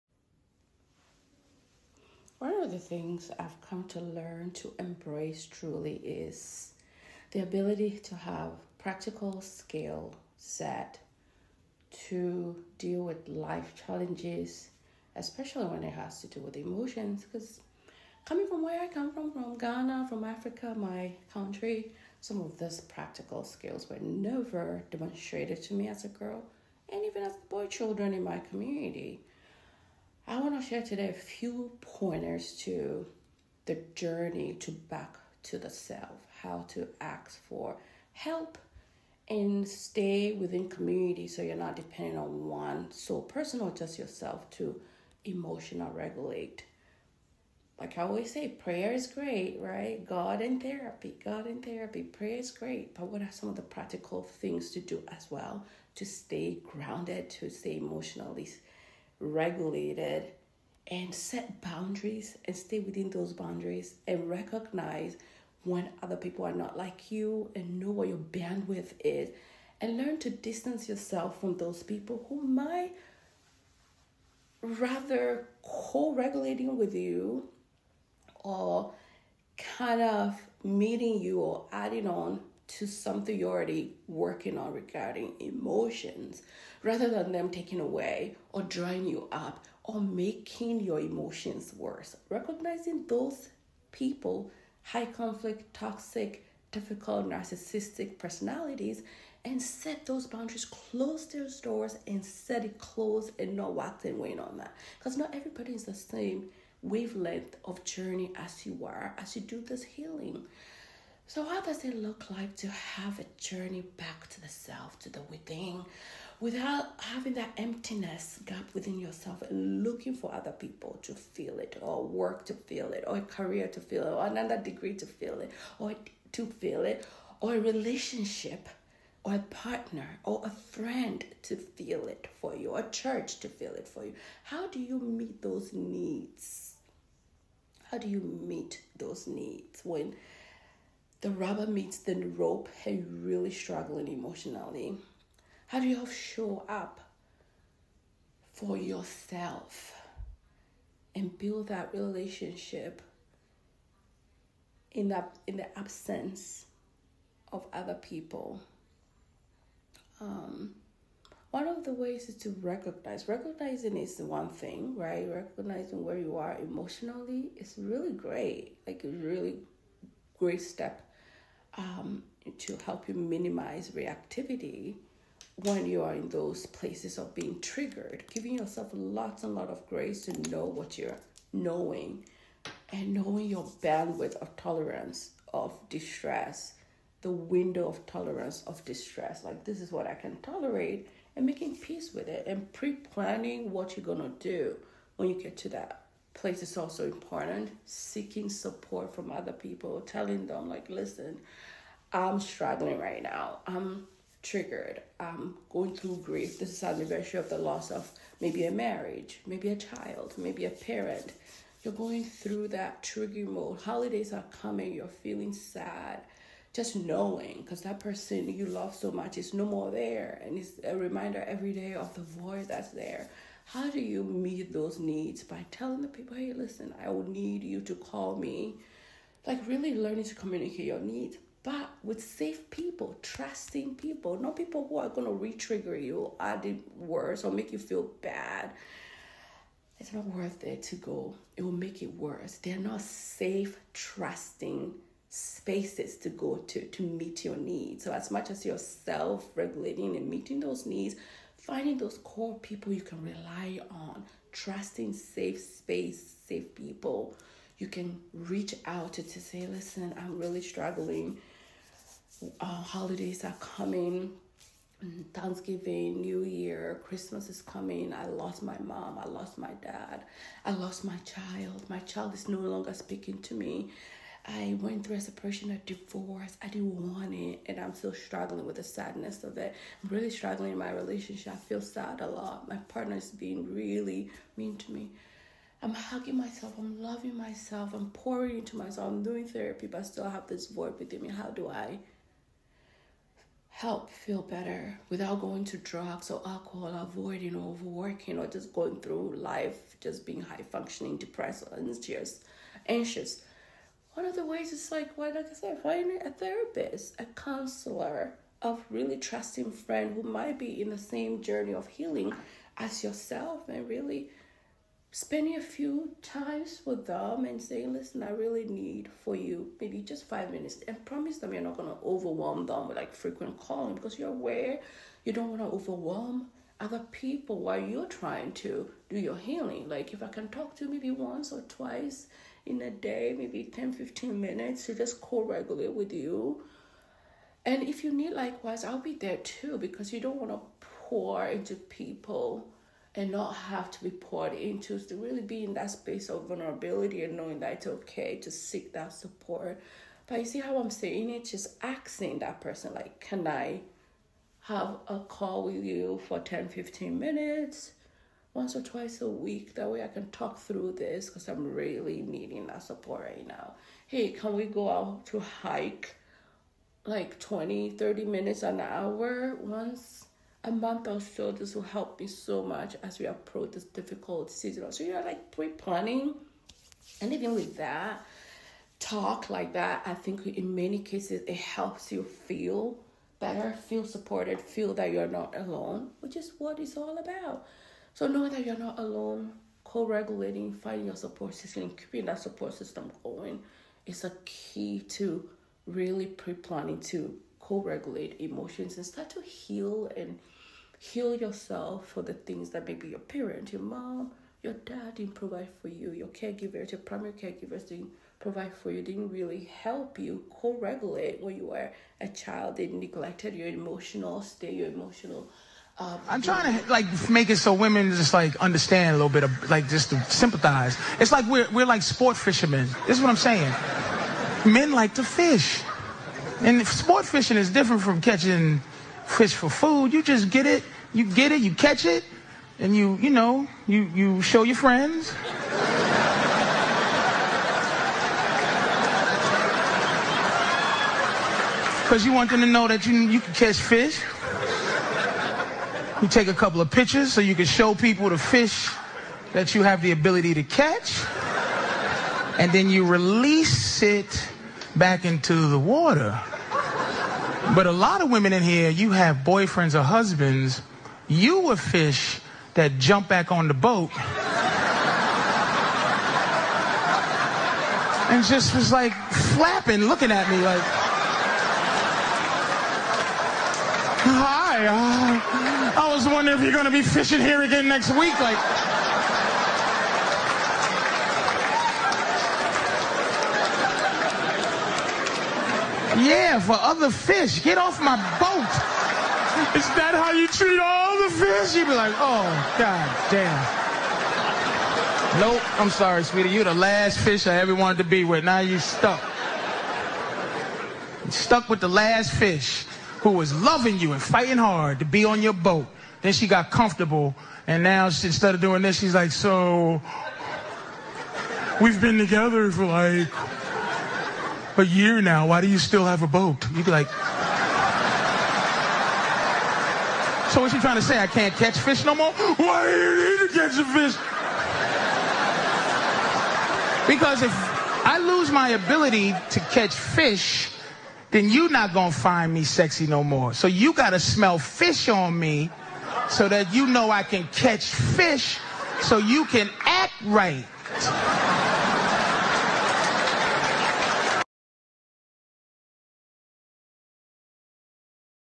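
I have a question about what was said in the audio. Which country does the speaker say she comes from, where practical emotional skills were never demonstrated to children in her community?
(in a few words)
Ghana.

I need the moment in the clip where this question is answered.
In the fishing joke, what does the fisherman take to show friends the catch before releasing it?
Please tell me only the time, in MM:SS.
07:26.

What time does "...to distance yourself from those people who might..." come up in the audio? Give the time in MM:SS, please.
01:10.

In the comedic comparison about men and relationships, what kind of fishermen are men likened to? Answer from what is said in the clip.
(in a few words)
sport fishermen.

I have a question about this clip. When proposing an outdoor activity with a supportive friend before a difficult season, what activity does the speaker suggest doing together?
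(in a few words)
hike.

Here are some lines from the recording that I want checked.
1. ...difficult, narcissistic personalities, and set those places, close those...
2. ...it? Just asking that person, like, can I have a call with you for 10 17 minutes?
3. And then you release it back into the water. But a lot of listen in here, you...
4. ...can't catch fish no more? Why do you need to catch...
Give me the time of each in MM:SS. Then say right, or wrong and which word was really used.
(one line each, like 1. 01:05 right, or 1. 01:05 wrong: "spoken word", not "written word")
1. 01:36 wrong: "boundaries", not "places"
2. 05:51 wrong: "15", not "17"
3. 07:32 wrong: "women", not "listen"
4. 08:41 right.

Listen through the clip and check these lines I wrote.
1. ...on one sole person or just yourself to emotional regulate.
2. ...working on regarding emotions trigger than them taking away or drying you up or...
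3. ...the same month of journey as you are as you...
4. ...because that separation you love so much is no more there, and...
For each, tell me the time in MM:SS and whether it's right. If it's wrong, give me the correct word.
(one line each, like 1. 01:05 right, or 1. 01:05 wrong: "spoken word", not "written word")
1. 00:42 right
2. 01:24 wrong: "rather", not "trigger"
3. 01:45 wrong: "wavelength", not "month"
4. 03:37 wrong: "person", not "separation".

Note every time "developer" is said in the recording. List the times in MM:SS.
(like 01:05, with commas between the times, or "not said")
not said.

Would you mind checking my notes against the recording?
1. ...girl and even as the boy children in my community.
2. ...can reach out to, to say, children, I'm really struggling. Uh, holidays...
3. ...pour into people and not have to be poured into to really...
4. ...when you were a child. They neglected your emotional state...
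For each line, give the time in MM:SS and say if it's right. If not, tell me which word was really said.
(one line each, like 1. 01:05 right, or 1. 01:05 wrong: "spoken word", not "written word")
1. 00:26 right
2. 04:17 wrong: "listen", not "children"
3. 05:41 right
4. 06:51 right.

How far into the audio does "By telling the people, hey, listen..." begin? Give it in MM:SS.
03:45.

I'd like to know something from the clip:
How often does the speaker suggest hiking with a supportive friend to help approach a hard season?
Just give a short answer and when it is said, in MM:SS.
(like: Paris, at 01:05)
once a month, at 06:09.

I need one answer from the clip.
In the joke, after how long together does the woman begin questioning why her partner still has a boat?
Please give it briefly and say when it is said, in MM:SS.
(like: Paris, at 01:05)
a year, at 08:34.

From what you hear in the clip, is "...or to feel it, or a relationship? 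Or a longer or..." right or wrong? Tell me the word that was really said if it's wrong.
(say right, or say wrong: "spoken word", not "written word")
wrong: "partner", not "longer".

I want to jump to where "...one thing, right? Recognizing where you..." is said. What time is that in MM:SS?
02:44.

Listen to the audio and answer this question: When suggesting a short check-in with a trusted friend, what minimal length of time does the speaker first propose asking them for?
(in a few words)
5 minutes.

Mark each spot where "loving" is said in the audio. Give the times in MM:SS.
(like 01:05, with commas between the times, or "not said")
04:47, 08:23.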